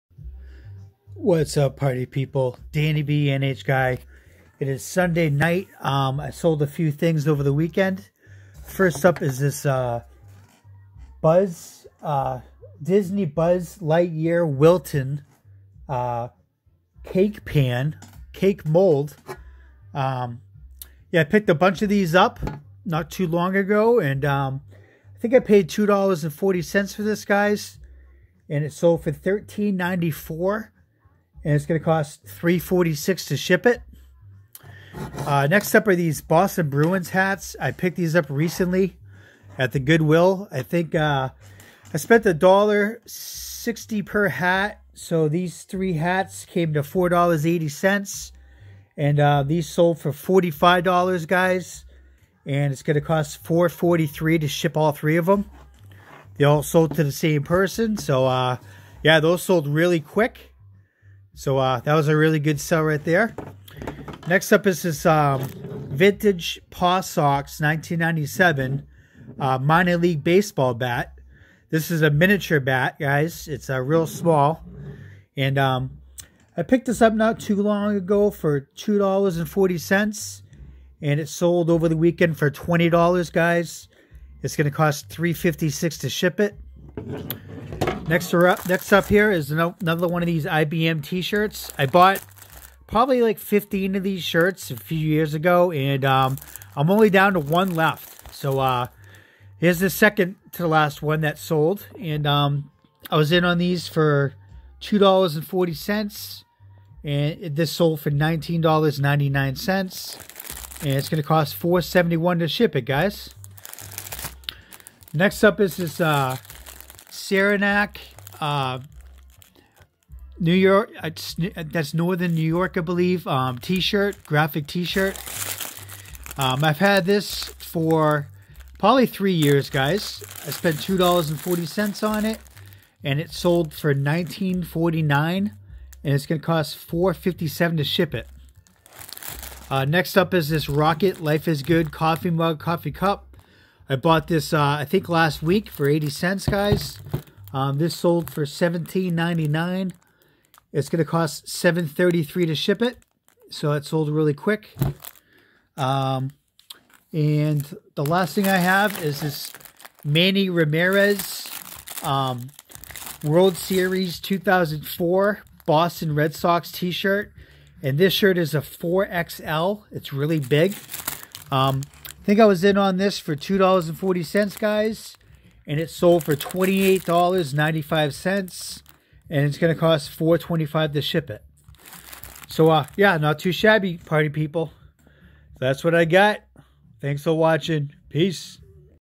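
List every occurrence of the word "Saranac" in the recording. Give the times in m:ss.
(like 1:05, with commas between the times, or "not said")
1:57.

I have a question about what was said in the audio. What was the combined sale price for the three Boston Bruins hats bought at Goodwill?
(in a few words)
$45.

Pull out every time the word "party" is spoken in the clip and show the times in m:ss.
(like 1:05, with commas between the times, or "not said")
0:01, 3:03.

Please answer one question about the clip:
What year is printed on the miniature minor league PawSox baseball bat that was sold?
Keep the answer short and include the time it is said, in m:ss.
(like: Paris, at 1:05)
1997, at 1:07.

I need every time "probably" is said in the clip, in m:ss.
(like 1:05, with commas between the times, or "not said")
1:32, 2:08.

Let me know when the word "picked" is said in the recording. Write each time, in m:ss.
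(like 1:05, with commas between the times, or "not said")
0:21, 0:37, 1:16.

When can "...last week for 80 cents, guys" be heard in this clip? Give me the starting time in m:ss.
2:25.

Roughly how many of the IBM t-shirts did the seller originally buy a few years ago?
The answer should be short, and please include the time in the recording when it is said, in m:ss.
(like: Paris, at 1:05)
15, at 1:33.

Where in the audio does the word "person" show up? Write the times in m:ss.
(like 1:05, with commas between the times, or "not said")
0:57.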